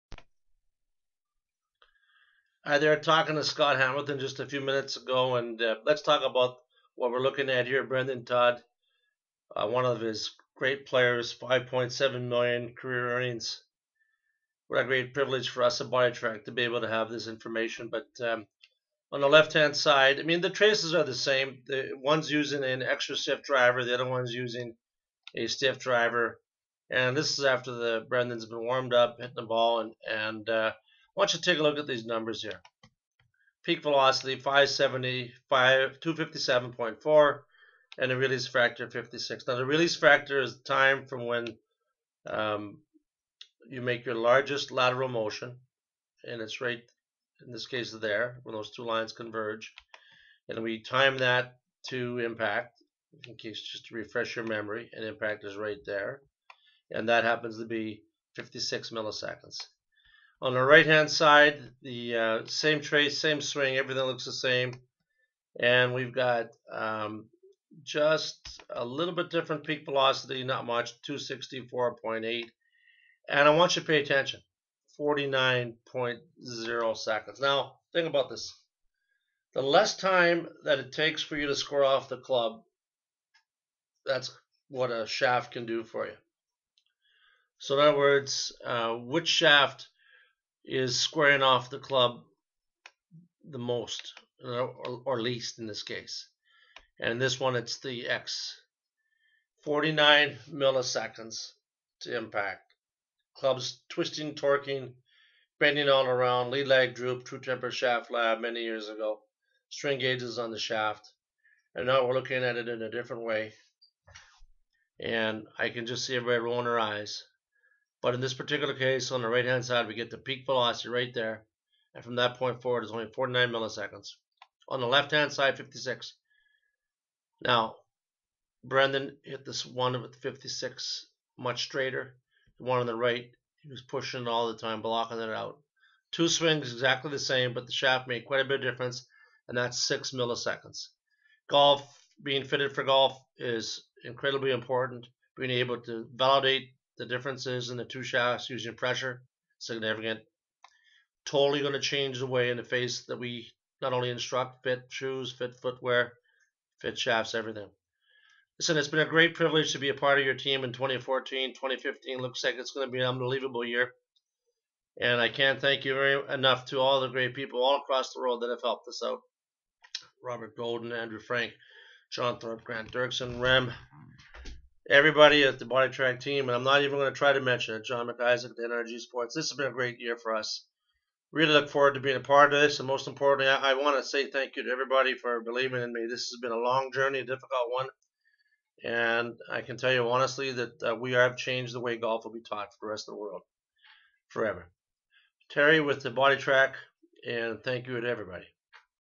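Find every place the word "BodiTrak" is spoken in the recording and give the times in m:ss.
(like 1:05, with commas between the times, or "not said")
0:15, 2:55, 3:16.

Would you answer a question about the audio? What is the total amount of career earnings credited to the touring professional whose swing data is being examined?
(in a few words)
5.7 million.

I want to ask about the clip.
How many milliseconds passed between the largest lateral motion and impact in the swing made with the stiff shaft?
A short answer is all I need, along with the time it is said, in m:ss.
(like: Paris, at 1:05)
56, at 0:58.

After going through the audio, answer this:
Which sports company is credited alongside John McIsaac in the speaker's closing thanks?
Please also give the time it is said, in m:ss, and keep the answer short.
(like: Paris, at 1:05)
NRG Sports, at 2:58.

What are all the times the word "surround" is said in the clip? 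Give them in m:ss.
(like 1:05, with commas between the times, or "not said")
not said.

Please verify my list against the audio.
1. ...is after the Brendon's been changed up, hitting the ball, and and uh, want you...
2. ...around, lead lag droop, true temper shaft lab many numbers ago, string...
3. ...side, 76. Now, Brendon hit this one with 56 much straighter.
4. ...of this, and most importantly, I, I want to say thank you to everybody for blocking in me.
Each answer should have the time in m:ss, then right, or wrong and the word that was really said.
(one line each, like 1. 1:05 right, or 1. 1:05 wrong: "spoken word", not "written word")
1. 0:27 wrong: "warmed", not "changed"
2. 1:46 wrong: "years", not "numbers"
3. 2:05 wrong: "56", not "76"
4. 3:02 wrong: "believing", not "blocking".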